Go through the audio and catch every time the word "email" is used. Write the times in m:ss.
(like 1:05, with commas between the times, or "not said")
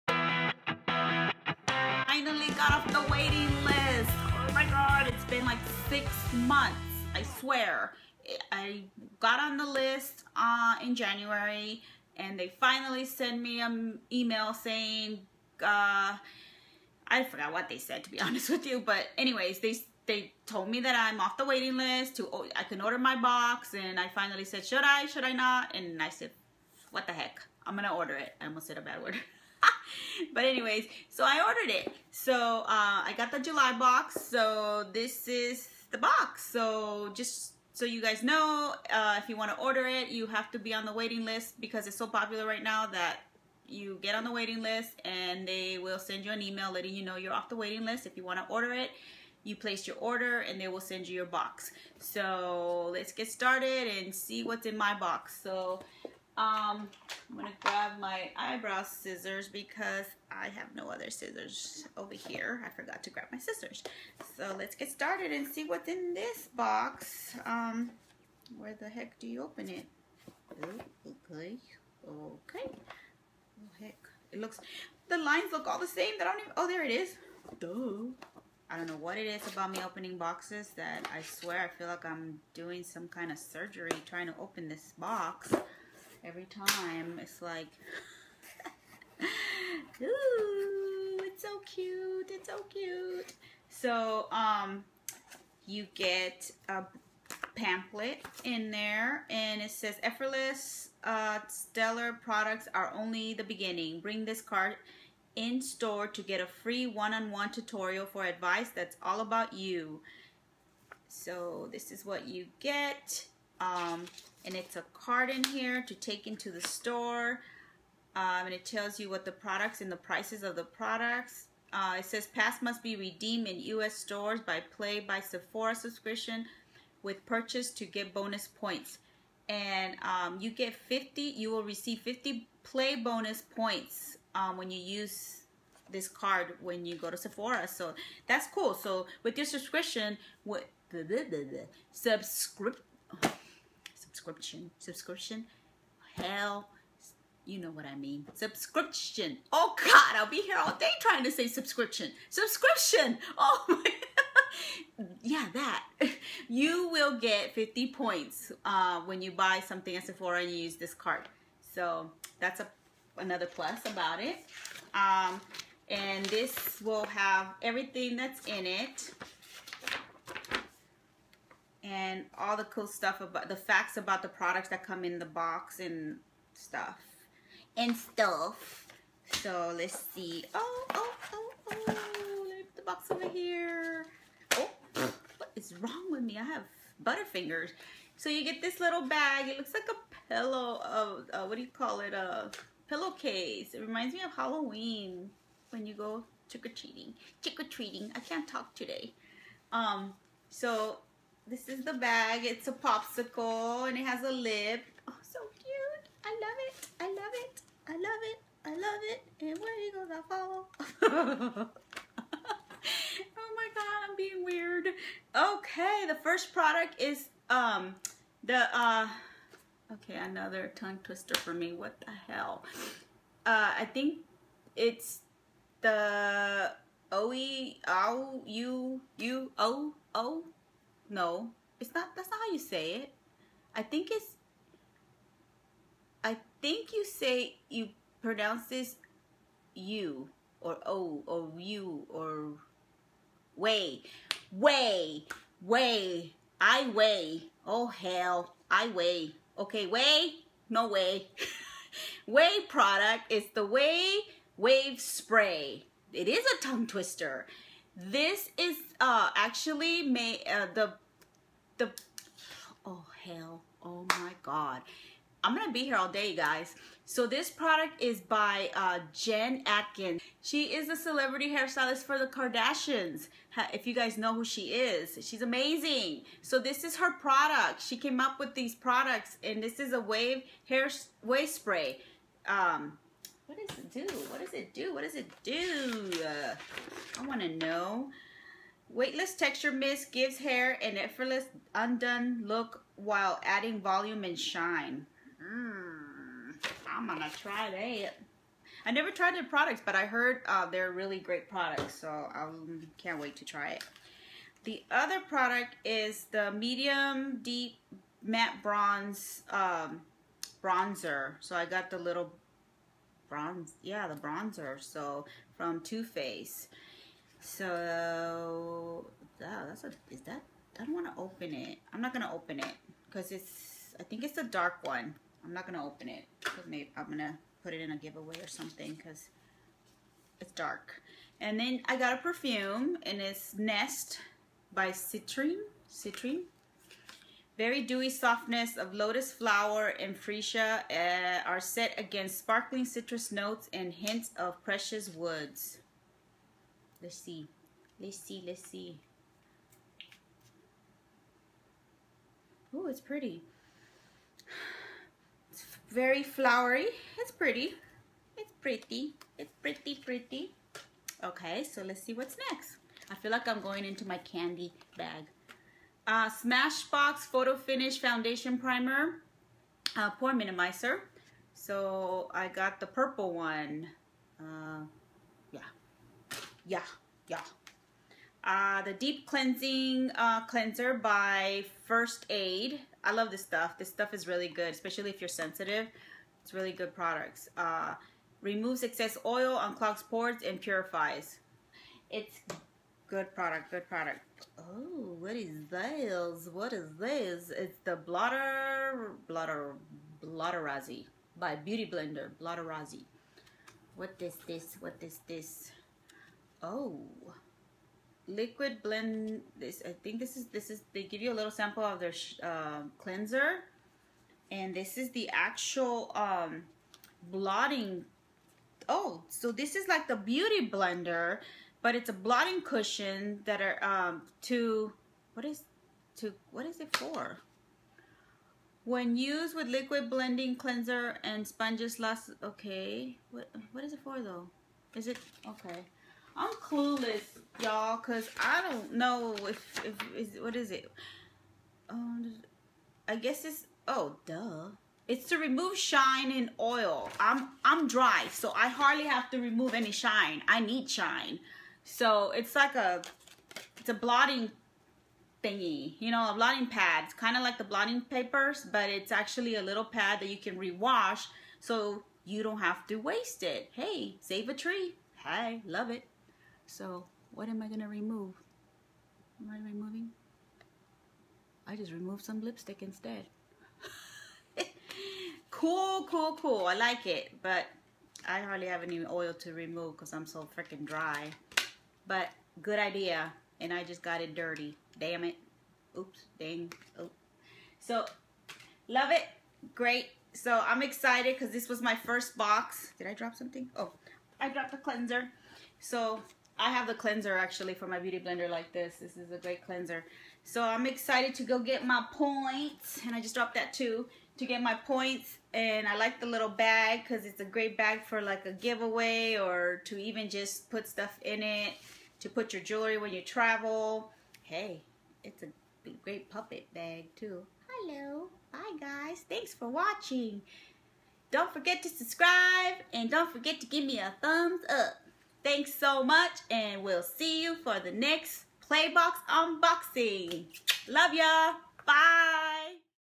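0:14, 0:46.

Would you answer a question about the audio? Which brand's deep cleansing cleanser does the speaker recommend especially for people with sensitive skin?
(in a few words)
First Aid.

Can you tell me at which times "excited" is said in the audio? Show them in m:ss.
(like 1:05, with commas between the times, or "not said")
8:10, 8:20.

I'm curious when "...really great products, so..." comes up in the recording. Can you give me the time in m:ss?
5:00.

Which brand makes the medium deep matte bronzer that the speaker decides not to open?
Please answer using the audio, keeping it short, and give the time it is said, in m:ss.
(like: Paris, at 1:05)
Too Faced, at 5:15.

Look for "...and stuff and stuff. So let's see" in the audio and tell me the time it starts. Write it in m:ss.
2:55.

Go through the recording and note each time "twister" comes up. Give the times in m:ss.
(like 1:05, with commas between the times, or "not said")
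3:41, 4:16.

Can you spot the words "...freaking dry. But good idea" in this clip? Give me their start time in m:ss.
8:00.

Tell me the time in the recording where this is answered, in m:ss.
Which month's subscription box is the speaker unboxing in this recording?
0:33.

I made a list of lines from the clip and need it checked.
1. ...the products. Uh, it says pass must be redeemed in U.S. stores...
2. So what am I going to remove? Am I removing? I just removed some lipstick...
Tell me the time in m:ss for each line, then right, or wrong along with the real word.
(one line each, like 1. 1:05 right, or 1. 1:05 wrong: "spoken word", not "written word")
1. 2:00 right
2. 7:46 right.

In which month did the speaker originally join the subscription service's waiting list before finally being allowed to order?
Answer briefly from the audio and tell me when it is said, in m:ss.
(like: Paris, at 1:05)
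January, at 0:10.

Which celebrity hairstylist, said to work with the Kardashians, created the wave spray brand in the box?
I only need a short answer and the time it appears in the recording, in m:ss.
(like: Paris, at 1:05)
Jen Atkins, at 4:29.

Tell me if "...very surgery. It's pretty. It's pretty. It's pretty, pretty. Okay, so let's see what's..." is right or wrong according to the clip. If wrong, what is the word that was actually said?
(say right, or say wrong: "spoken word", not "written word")
wrong: "flowery", not "surgery".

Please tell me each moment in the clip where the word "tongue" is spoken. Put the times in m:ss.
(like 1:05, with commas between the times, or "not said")
3:40, 4:16.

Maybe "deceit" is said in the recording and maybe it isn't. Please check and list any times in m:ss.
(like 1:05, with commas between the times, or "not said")
not said.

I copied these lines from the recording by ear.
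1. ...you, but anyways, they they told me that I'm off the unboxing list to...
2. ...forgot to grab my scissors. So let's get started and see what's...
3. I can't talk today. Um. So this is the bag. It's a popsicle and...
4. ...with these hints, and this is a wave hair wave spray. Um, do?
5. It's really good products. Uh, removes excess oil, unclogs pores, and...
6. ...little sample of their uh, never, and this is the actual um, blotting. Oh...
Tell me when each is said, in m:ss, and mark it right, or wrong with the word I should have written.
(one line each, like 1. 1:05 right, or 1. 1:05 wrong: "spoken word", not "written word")
1. 0:18 wrong: "waiting", not "unboxing"
2. 1:02 right
3. 3:18 right
4. 4:38 wrong: "products", not "hints"
5. 6:26 right
6. 6:51 wrong: "cleanser", not "never".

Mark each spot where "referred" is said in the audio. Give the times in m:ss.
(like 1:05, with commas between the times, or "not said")
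not said.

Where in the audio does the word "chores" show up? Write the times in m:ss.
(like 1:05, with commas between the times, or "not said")
not said.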